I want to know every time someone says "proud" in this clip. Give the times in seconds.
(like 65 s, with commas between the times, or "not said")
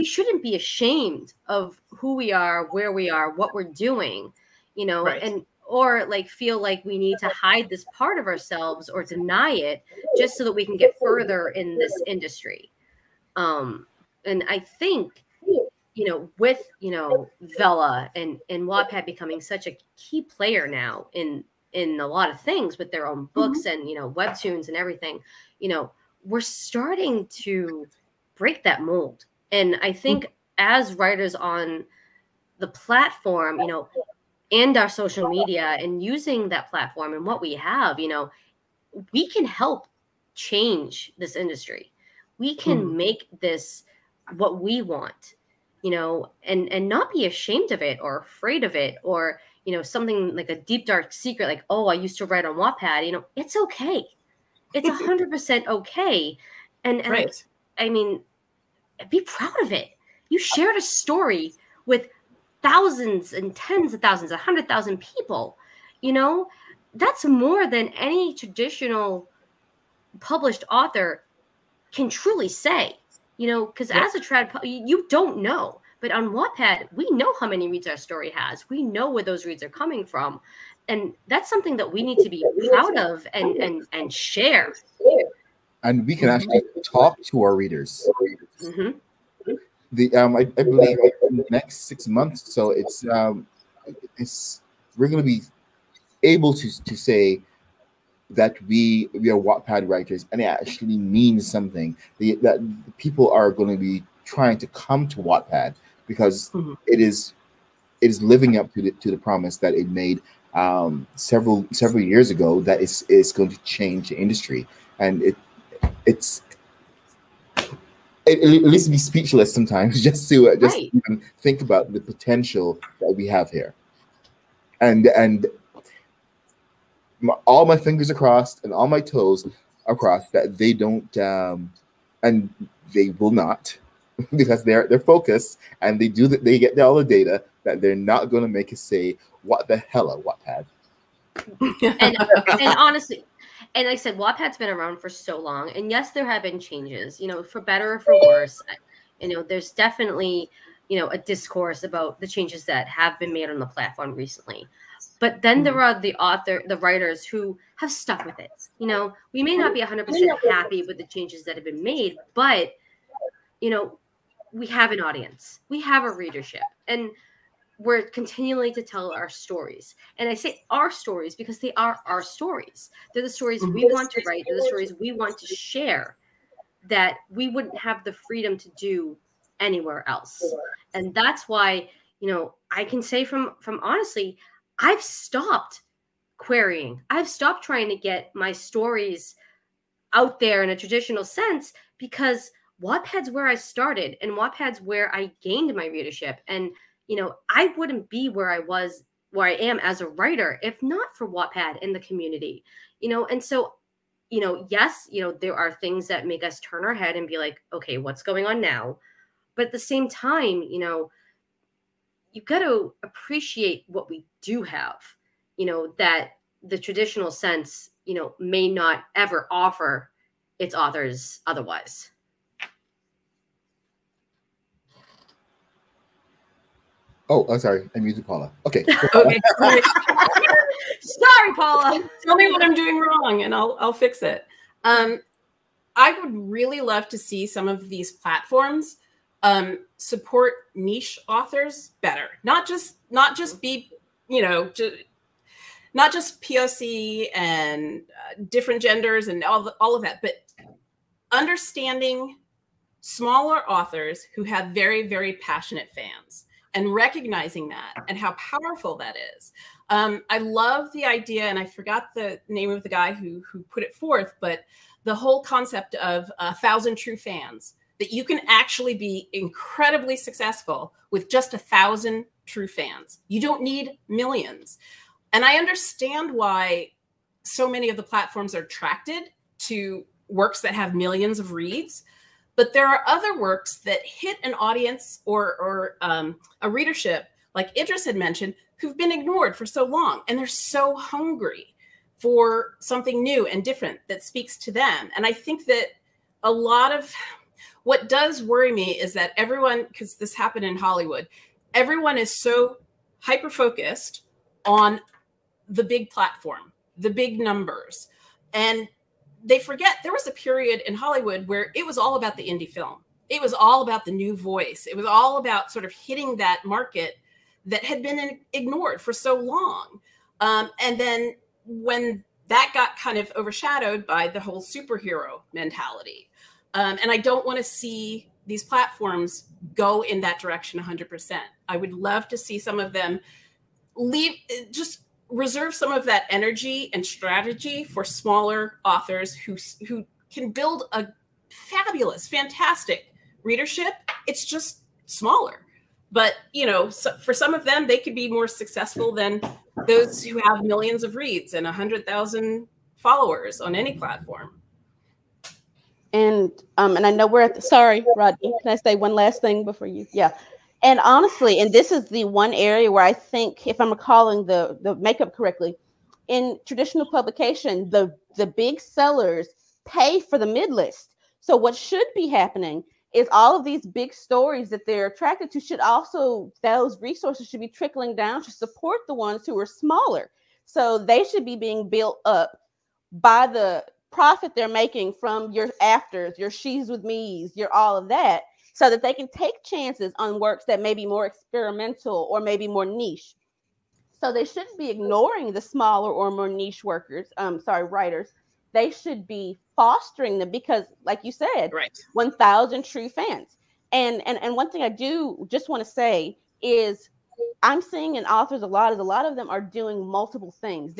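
59 s, 82 s.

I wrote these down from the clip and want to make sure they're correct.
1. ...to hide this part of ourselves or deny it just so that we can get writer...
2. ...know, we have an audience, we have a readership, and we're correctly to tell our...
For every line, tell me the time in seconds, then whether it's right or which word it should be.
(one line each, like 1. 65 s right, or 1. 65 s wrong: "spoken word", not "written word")
1. 7 s wrong: "further", not "writer"
2. 163 s wrong: "continually", not "correctly".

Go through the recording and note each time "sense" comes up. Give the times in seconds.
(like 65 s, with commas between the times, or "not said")
191 s, 217 s.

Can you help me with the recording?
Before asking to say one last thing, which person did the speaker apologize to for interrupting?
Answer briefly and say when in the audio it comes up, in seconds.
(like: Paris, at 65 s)
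Rodney, at 358 s.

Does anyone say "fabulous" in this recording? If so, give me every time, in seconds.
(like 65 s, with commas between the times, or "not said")
341 s.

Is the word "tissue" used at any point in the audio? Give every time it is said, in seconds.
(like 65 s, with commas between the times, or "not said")
not said.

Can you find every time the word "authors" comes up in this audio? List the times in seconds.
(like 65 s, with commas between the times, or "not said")
70 s, 156 s, 220 s, 241 s, 253 s, 338 s, 408 s.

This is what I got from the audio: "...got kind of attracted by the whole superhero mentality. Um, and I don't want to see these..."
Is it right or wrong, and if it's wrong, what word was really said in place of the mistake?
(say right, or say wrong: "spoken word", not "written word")
wrong: "overshadowed", not "attracted".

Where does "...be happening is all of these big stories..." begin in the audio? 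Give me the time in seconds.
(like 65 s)
372 s.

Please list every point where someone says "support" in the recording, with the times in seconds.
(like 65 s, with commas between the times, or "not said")
239 s, 378 s.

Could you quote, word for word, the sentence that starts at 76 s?
But on Wattpad, we know how many reads our story has.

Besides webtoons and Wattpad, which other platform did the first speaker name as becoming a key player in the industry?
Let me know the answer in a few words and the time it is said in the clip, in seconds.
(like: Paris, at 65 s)
Vella, at 17 s.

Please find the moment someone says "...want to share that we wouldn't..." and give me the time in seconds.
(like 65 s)
175 s.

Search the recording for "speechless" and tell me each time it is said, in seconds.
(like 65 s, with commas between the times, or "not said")
118 s.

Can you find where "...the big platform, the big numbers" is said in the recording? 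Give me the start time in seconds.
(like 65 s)
305 s.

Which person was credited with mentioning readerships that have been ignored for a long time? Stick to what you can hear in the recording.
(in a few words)
Idris.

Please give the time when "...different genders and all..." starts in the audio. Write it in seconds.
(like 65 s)
248 s.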